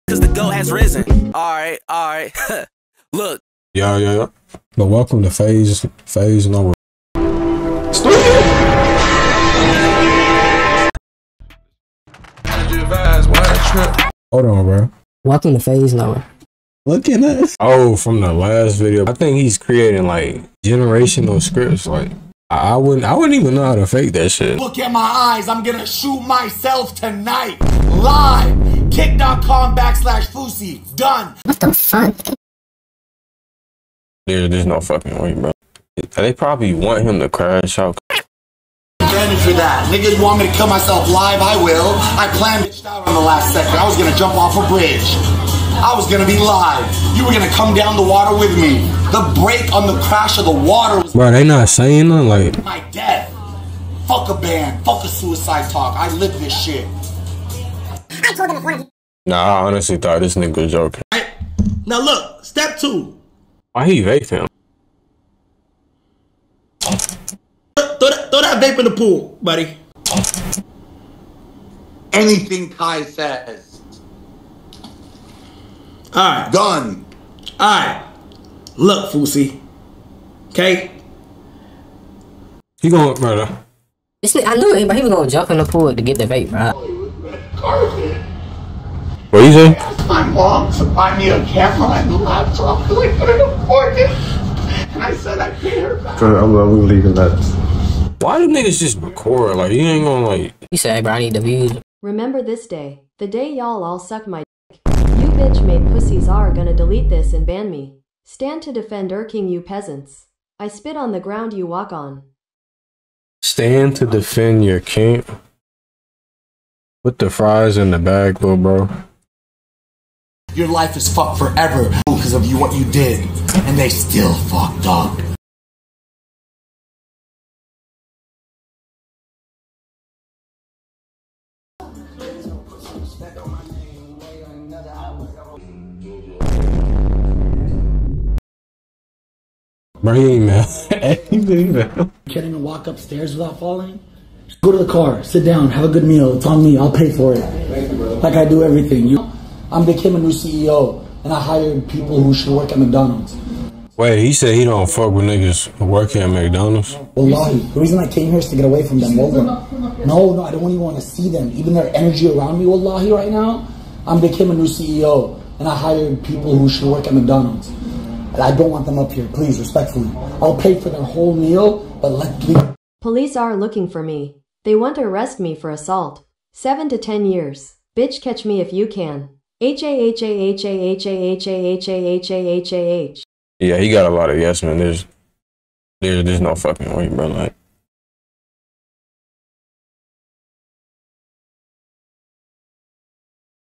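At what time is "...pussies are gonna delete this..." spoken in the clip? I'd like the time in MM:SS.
01:45.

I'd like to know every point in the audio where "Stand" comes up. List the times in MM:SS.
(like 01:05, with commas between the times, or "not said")
01:48, 01:53.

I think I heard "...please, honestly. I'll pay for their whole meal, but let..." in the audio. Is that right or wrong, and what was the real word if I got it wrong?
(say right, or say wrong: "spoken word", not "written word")
wrong: "respectfully", not "honestly".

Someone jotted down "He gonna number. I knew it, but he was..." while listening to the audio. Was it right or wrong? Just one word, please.
wrong.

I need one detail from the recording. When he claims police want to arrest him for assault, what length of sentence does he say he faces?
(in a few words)
7 to 10 years.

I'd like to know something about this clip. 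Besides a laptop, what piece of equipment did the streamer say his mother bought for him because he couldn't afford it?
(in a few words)
camera.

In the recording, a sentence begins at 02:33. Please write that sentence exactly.
Wait, he said he don't fuck with niggas working at McDonald's.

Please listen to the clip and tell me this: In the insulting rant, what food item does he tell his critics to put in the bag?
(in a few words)
fries.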